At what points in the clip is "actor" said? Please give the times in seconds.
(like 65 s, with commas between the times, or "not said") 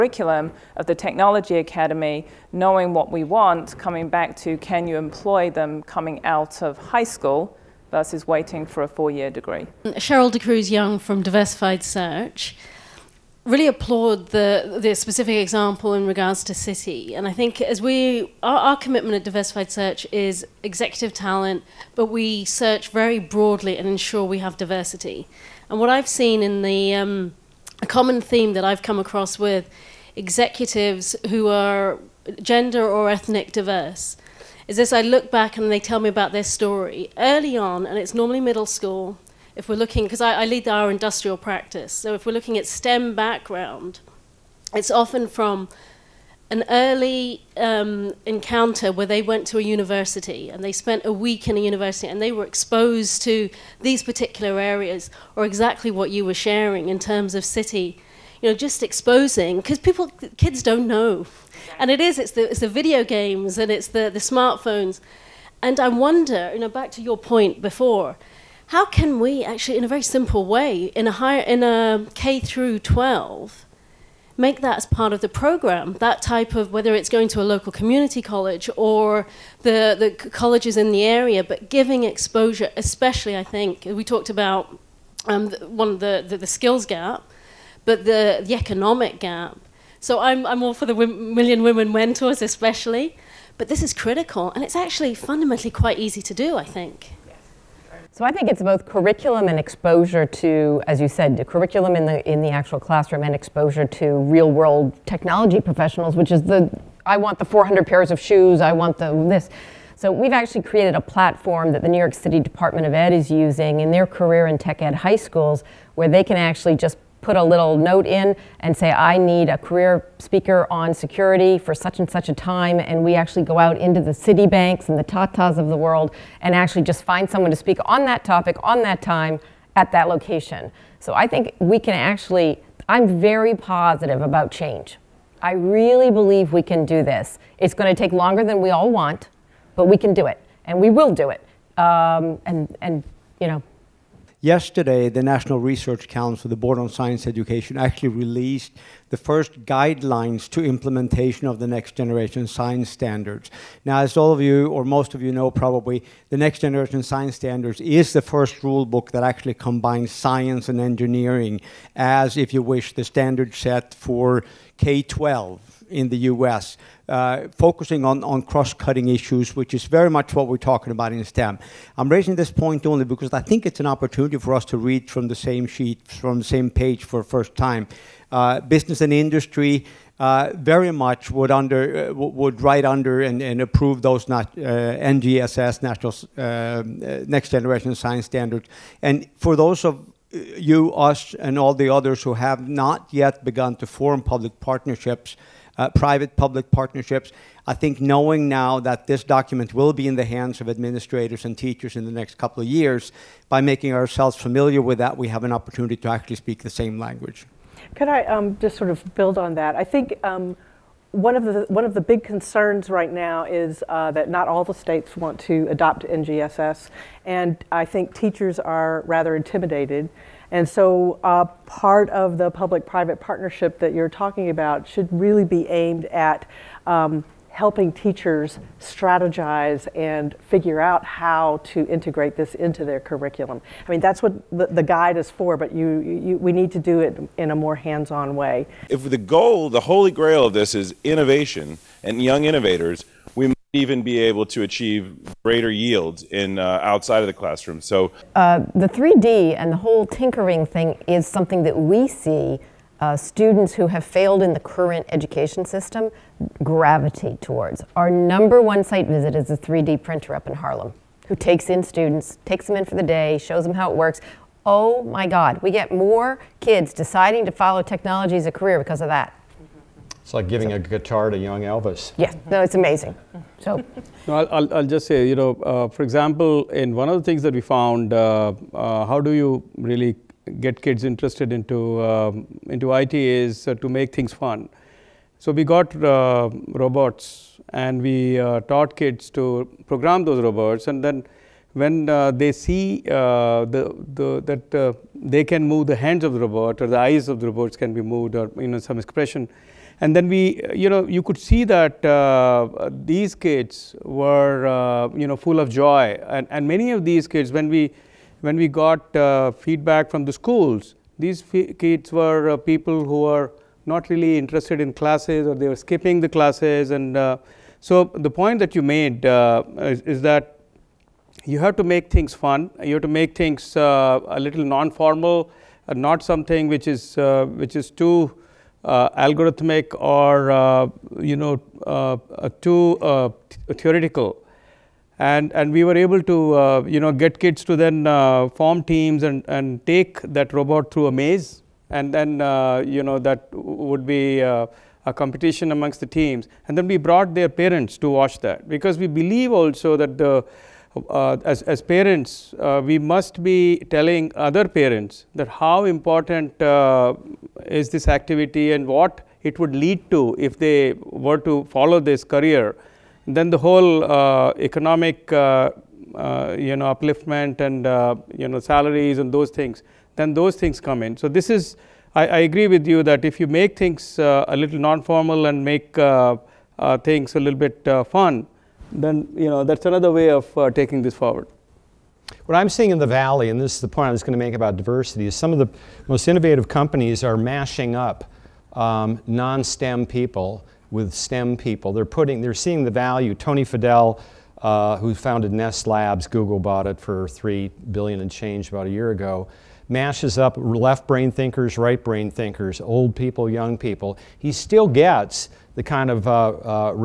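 not said.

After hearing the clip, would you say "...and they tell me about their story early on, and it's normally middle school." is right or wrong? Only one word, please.
right.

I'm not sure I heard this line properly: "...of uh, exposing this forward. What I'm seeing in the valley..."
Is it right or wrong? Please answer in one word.
wrong.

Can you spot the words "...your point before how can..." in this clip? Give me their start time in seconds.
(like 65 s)
67 s.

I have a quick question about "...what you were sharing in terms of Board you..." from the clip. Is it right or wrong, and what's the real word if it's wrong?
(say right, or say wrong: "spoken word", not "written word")
wrong: "Citi", not "Board".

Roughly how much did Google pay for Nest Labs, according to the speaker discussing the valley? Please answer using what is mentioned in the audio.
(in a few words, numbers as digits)
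3 billion.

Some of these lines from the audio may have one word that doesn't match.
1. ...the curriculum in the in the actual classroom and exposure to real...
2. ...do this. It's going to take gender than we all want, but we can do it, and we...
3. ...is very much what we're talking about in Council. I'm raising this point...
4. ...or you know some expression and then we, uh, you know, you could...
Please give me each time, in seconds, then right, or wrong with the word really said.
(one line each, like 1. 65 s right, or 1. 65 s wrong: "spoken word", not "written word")
1. 101 s right
2. 136 s wrong: "longer", not "gender"
3. 169 s wrong: "STEM", not "Council"
4. 298 s right.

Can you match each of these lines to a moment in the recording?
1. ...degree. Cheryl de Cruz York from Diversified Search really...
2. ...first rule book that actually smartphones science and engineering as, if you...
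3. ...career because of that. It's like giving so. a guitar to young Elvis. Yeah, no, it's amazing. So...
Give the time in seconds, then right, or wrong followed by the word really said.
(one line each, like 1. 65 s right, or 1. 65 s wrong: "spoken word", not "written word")
1. 9 s wrong: "Young", not "York"
2. 158 s wrong: "combines", not "smartphones"
3. 268 s right.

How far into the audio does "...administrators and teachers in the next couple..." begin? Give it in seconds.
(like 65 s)
200 s.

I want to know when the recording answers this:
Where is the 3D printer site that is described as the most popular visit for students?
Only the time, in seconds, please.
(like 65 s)
260 s.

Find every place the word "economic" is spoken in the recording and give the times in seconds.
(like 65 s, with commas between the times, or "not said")
88 s, 364 s.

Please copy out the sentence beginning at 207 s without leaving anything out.
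Could I um, just sort of build on that?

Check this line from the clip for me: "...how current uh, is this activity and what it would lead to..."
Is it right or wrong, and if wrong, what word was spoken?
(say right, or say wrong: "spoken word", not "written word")
wrong: "important", not "current".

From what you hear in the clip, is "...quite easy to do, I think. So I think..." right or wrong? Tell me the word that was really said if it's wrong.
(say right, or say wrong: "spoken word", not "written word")
right.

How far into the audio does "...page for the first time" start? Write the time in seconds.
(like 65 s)
176 s.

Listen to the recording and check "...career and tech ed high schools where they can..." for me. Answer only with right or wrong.
right.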